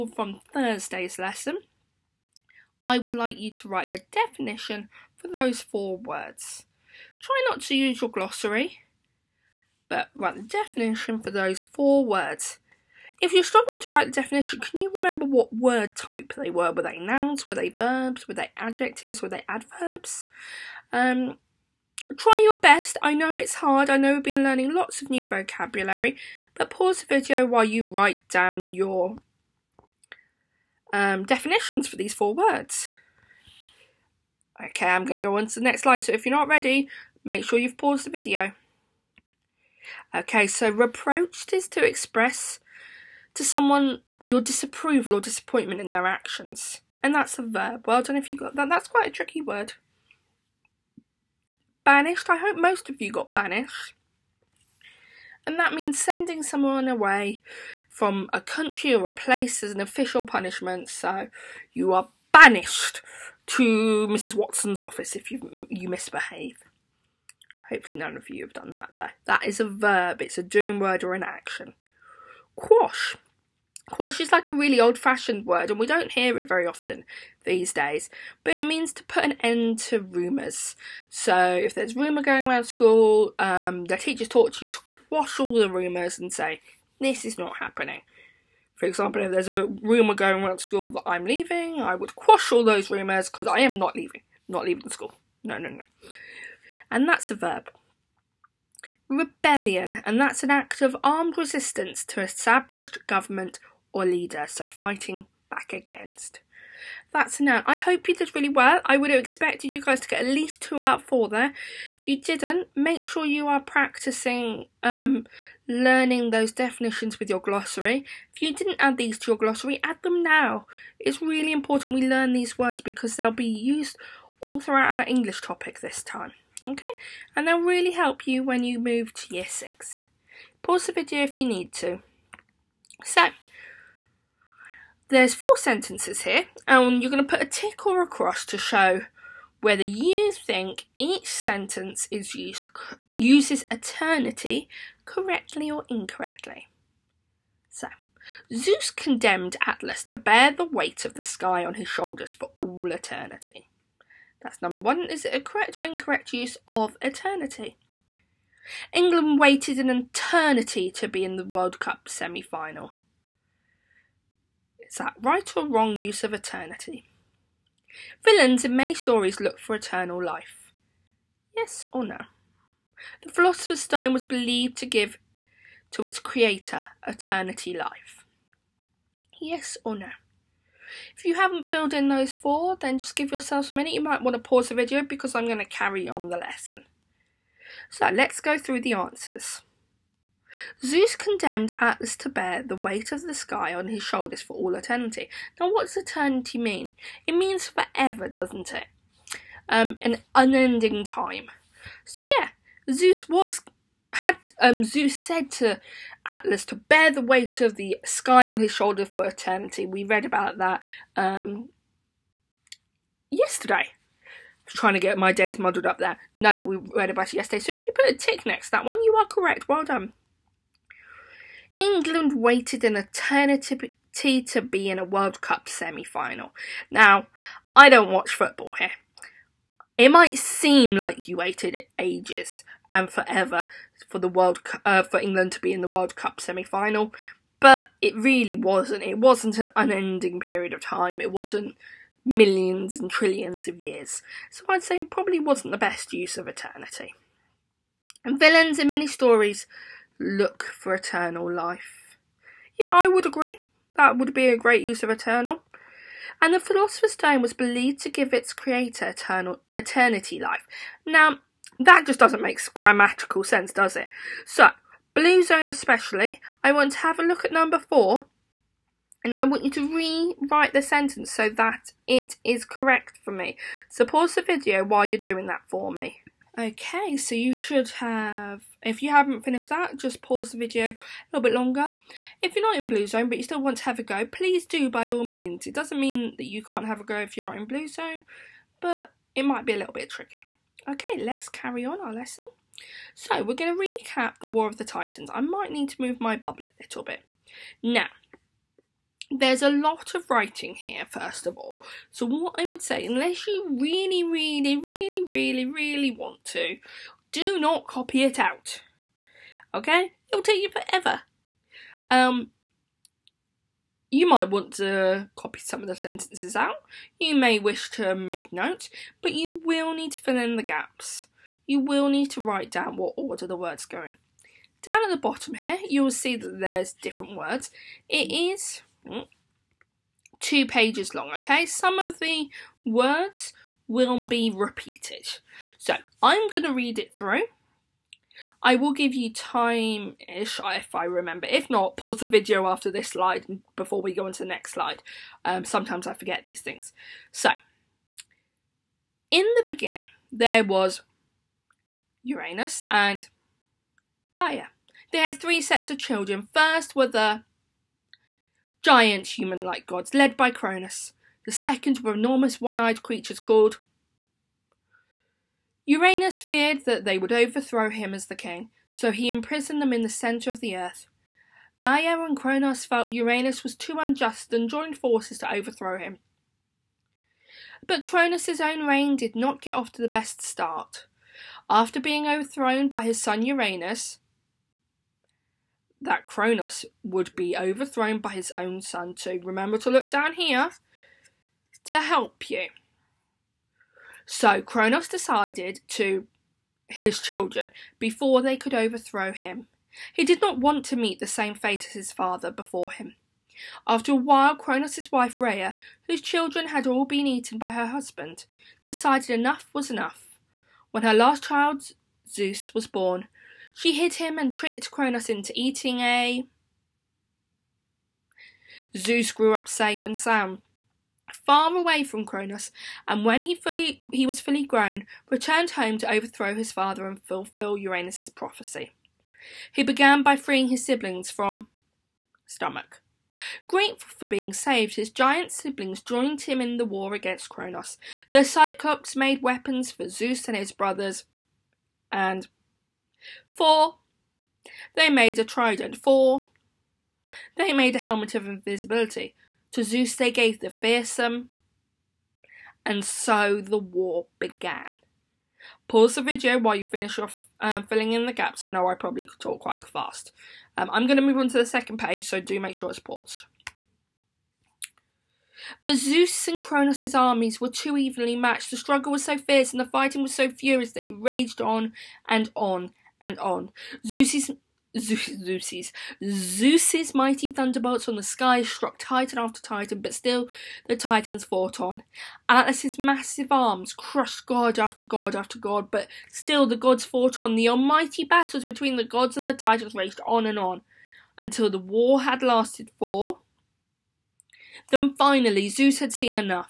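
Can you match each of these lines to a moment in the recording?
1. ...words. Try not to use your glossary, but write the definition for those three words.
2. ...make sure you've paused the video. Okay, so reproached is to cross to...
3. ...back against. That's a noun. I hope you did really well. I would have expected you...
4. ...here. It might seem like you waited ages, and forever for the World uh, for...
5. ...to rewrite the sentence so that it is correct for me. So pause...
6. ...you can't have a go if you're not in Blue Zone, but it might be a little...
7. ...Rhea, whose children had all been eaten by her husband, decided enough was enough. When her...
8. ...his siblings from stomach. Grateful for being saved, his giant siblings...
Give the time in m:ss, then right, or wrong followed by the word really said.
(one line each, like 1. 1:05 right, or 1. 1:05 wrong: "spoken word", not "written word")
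1. 0:05 wrong: "four", not "three"
2. 0:37 wrong: "express", not "cross"
3. 1:45 right
4. 3:48 right
5. 4:29 right
6. 4:46 right
7. 6:45 right
8. 7:10 right.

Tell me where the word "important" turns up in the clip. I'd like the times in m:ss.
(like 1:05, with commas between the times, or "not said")
2:01.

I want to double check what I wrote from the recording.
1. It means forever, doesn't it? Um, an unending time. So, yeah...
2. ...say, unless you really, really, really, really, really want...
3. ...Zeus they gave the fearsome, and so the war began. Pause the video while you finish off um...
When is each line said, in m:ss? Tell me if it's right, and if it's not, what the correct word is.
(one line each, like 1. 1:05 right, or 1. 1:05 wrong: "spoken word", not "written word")
1. 3:17 right
2. 5:02 right
3. 7:29 right.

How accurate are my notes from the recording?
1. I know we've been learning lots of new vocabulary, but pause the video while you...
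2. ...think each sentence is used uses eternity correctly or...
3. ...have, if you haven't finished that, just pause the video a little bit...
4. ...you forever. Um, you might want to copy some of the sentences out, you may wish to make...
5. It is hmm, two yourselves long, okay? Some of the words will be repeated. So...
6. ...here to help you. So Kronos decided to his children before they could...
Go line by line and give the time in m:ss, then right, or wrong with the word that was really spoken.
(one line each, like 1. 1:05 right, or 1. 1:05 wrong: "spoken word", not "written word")
1. 0:23 right
2. 2:20 right
3. 4:37 right
4. 5:10 right
5. 5:28 wrong: "pages", not "yourselves"
6. 6:30 right.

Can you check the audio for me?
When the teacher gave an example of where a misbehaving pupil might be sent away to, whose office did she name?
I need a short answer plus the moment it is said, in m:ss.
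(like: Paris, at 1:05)
Mrs. Watson's office, at 1:04.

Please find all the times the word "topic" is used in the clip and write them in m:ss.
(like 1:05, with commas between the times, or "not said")
2:05.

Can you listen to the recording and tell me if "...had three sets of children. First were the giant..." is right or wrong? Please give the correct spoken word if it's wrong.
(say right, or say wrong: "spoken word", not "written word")
right.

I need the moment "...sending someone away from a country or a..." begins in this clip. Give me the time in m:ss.
0:55.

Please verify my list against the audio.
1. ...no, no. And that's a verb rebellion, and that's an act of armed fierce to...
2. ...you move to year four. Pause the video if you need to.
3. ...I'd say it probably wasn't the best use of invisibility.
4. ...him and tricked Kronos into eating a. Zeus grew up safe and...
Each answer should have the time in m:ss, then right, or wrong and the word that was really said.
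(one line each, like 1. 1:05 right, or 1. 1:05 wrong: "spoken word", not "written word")
1. 1:35 wrong: "resistance", not "fierce"
2. 2:08 wrong: "six", not "four"
3. 4:04 wrong: "eternity", not "invisibility"
4. 6:54 right.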